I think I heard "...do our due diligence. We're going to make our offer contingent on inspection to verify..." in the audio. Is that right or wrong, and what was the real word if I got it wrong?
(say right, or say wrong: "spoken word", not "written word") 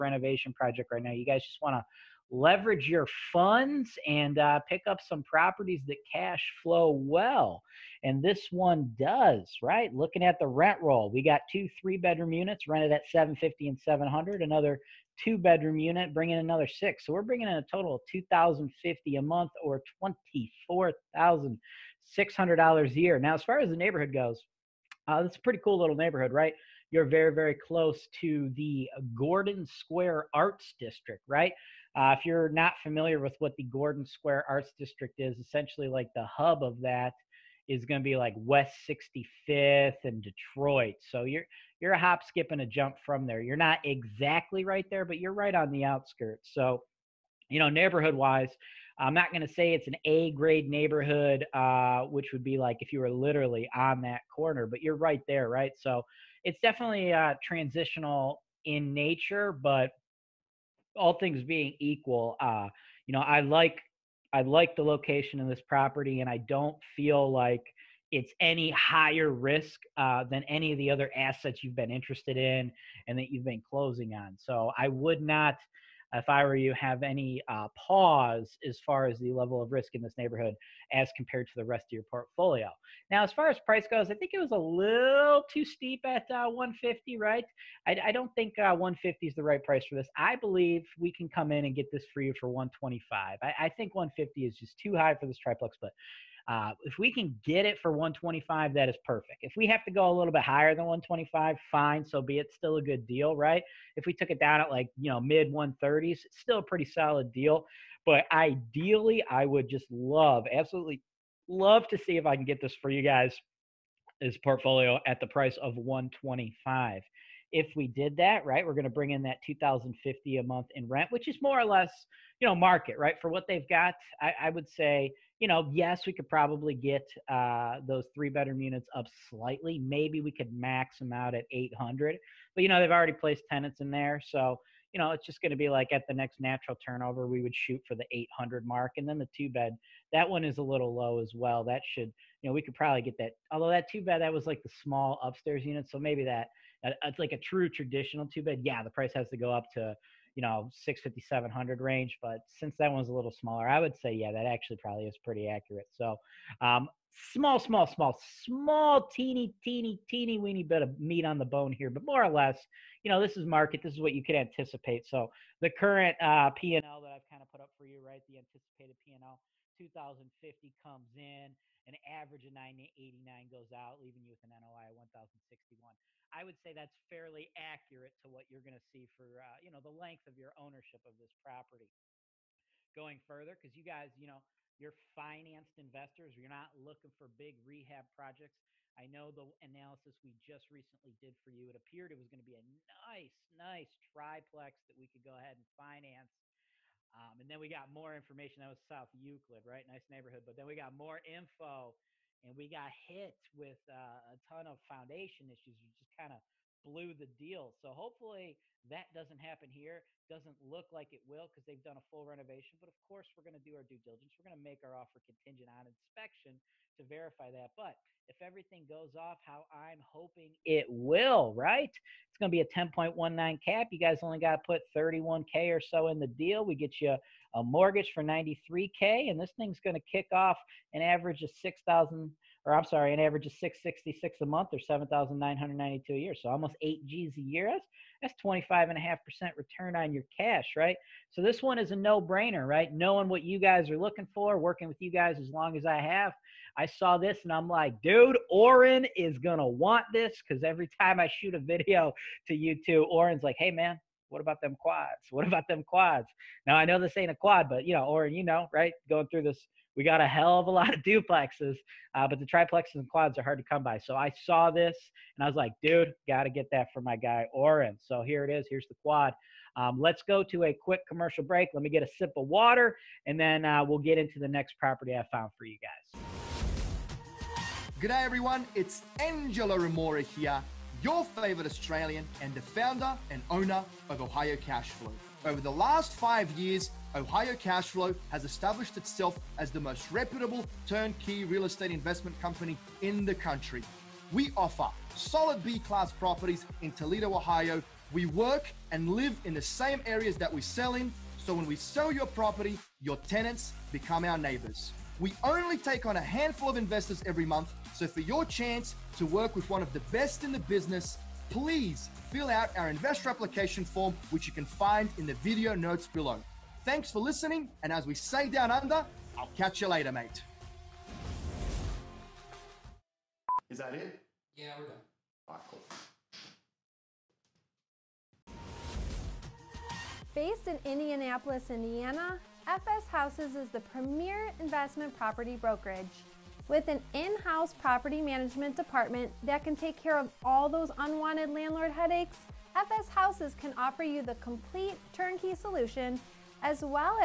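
right.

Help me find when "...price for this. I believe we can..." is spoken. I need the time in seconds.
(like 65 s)
89 s.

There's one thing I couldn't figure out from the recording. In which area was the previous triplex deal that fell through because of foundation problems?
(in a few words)
South Euclid.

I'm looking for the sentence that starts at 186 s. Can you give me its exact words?
You're not looking for big rehab projects.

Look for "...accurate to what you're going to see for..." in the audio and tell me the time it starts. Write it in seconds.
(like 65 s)
177 s.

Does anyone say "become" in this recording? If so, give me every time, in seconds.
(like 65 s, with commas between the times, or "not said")
303 s.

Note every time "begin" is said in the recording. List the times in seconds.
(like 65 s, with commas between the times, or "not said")
not said.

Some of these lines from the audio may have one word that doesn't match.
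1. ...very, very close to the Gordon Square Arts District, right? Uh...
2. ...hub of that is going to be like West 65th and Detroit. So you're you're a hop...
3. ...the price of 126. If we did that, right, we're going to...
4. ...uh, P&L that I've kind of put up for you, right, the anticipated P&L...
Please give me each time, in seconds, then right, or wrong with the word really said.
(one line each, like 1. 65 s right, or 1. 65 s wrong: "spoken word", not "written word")
1. 27 s right
2. 36 s right
3. 115 s wrong: "125", not "126"
4. 166 s right.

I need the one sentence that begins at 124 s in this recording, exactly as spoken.
I, I would say you know, yes, we could probably get uh, those three bedroom units up slightly.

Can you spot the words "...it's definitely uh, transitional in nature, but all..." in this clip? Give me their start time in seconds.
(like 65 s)
56 s.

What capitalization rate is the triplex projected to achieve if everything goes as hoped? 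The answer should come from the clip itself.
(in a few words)
10.19.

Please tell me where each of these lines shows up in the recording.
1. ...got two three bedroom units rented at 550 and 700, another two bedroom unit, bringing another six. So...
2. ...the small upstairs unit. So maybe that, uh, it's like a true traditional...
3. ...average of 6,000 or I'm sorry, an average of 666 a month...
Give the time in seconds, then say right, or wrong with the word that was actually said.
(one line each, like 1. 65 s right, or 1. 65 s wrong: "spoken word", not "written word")
1. 11 s wrong: "750", not "550"
2. 144 s right
3. 231 s right.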